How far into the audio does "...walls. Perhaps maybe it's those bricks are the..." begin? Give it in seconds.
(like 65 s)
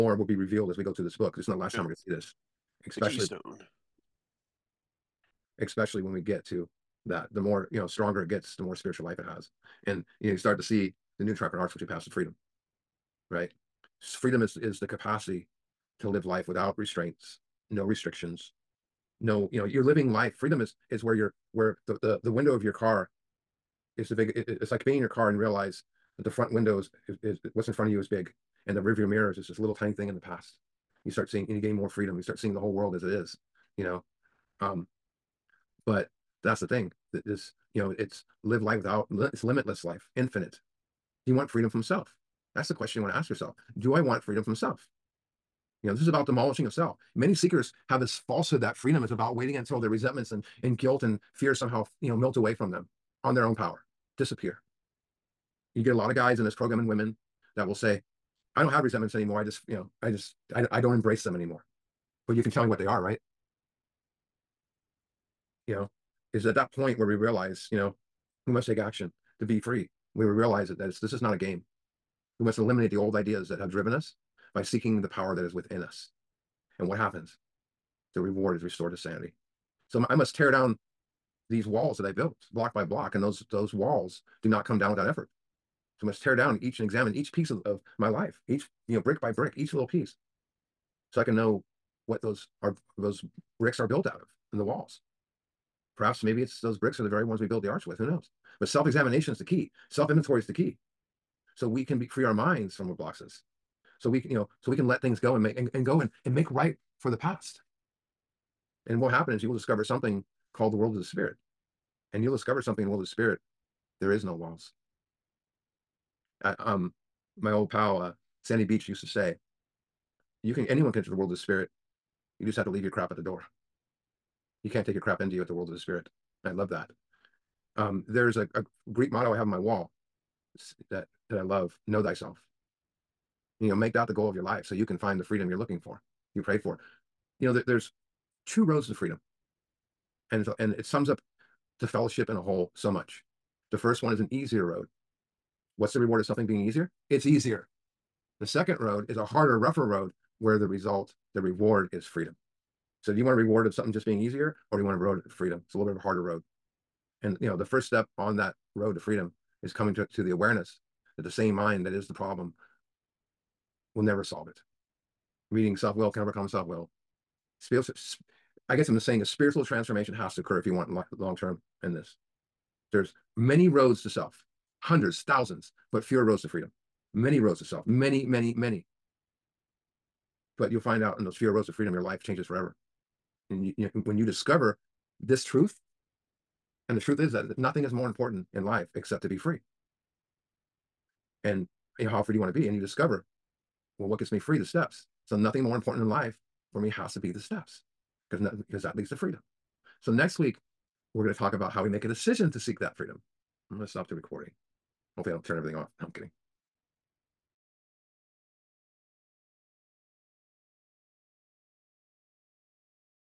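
94 s.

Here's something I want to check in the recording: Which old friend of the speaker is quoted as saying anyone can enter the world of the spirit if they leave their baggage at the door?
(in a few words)
Sandy Beach.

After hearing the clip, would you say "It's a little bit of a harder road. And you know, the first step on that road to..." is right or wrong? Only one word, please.
right.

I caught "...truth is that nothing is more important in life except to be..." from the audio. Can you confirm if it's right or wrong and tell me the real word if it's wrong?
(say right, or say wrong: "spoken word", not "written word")
right.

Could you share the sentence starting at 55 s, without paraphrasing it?
You get a lot of guys in this program and women that will say, I don't have resentments anymore.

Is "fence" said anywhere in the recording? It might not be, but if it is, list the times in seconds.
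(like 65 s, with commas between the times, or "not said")
not said.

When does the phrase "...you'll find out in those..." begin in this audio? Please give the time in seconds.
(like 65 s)
180 s.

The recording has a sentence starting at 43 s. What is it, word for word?
Do I want freedom from self?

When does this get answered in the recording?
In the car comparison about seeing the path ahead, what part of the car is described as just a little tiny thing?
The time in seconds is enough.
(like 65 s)
28 s.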